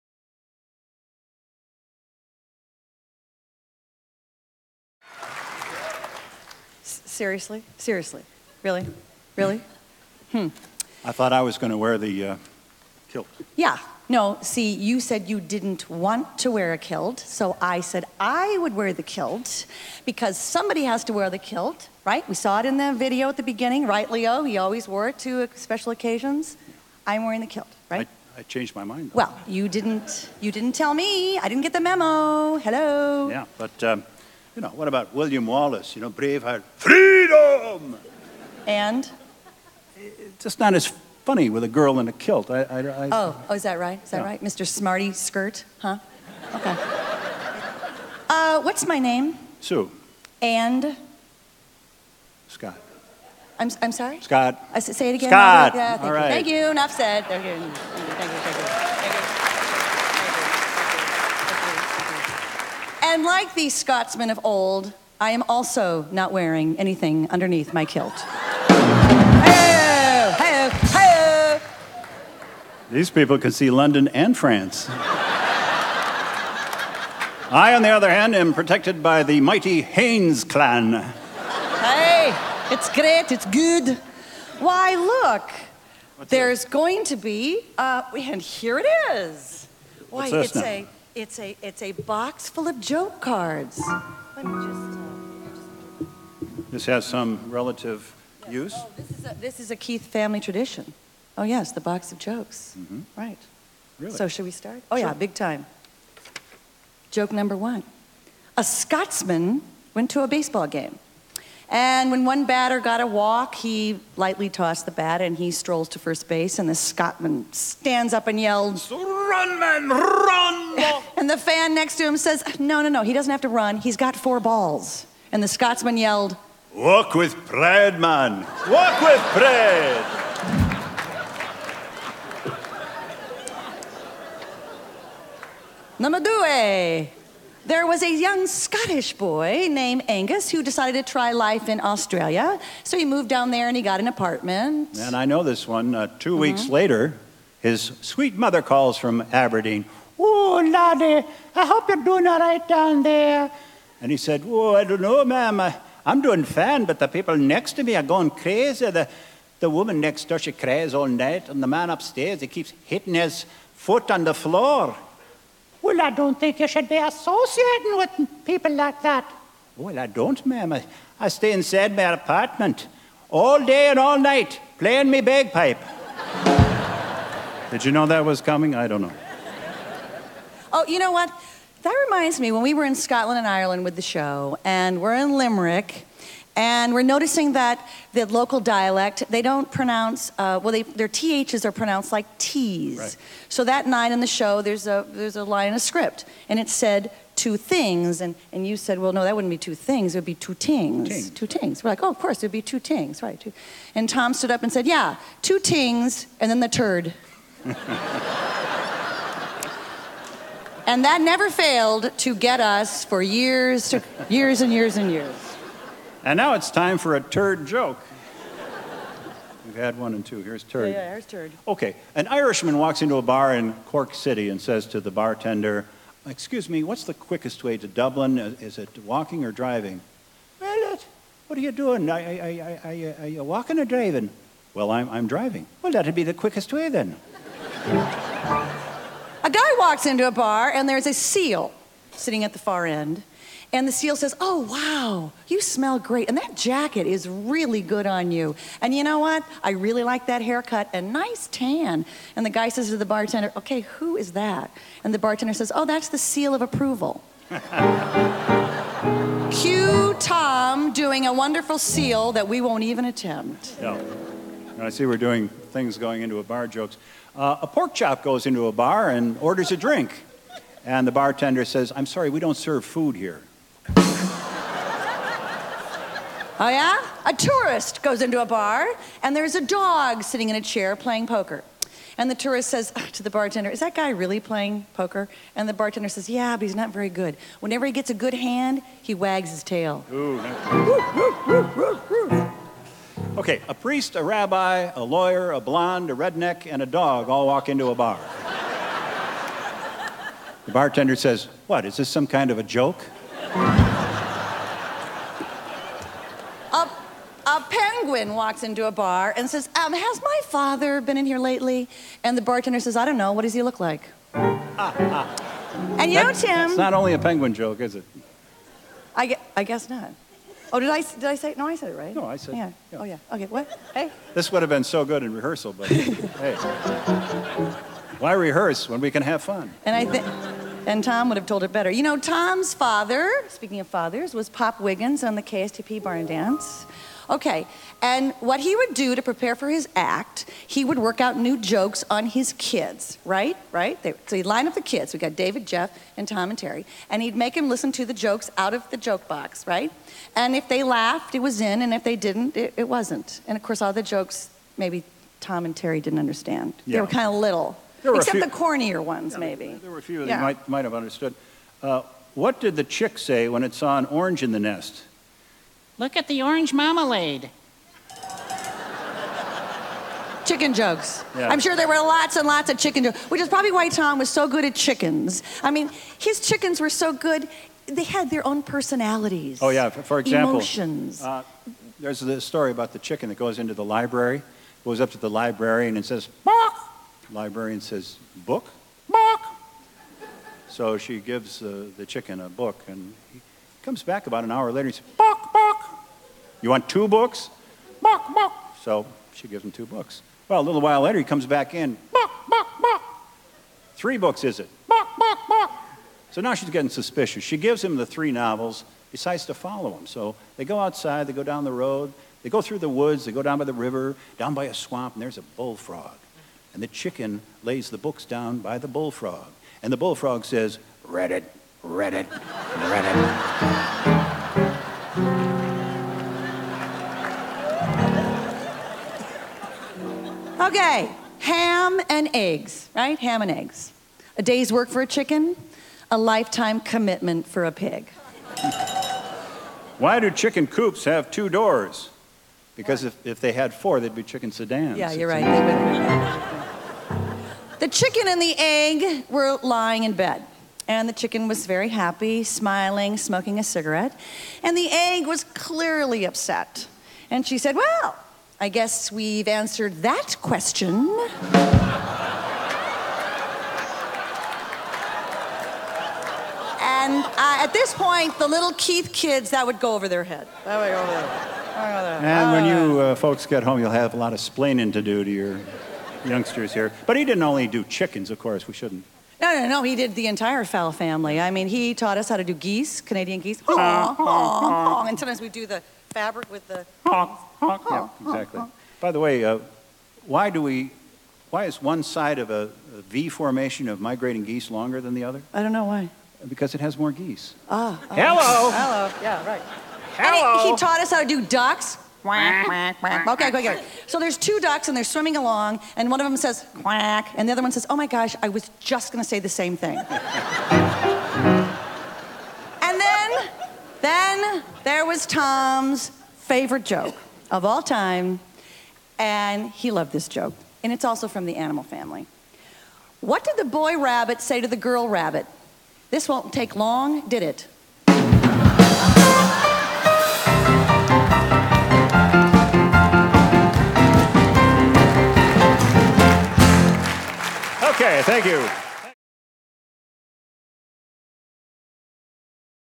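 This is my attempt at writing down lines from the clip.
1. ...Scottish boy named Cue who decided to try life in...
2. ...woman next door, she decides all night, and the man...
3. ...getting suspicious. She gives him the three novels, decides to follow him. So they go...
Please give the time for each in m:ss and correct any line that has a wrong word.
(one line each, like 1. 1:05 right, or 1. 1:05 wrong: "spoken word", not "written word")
1. 2:18 wrong: "Angus", not "Cue"
2. 2:39 wrong: "cries", not "decides"
3. 6:46 right.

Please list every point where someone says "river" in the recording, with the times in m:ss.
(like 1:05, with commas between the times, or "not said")
6:53.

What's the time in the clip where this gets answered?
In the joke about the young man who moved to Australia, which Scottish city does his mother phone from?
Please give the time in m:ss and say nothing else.
2:29.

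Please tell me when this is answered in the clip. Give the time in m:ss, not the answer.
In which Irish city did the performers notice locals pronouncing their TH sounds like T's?
3:05.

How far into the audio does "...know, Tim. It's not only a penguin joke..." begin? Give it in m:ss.
5:16.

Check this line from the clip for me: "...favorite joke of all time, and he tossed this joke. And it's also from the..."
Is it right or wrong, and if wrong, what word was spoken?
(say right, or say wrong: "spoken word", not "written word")
wrong: "loved", not "tossed".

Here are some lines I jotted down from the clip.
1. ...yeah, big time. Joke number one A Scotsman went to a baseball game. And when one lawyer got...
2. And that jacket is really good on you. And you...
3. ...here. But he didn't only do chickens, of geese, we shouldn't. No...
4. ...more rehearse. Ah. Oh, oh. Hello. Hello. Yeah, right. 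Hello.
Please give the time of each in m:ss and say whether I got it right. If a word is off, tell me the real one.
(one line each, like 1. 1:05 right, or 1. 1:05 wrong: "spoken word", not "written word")
1. 1:44 wrong: "batter", not "lawyer"
2. 4:06 right
3. 7:56 wrong: "course", not "geese"
4. 8:16 wrong: "geese", not "rehearse".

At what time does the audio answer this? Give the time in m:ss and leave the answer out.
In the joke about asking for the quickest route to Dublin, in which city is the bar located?
3:43.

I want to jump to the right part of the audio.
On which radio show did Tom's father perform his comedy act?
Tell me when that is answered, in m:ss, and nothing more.
5:35.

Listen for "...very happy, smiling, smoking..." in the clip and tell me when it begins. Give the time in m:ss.
7:31.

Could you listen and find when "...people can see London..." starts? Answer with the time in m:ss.
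1:13.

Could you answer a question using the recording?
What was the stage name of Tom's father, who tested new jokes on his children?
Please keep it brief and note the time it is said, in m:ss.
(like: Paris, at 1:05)
Pop Wiggins, at 5:34.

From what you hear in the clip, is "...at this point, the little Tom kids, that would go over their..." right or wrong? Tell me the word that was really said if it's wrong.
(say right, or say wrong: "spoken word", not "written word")
wrong: "Keith", not "Tom".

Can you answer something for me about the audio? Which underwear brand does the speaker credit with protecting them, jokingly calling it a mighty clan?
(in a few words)
Hanes.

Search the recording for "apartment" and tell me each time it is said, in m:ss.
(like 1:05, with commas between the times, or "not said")
2:24, 2:52.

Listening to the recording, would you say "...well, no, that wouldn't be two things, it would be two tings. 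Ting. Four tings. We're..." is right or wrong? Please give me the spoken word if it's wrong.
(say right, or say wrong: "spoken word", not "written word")
wrong: "Two", not "Four".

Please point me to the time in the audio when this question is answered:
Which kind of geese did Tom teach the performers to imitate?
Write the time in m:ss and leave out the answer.
8:03.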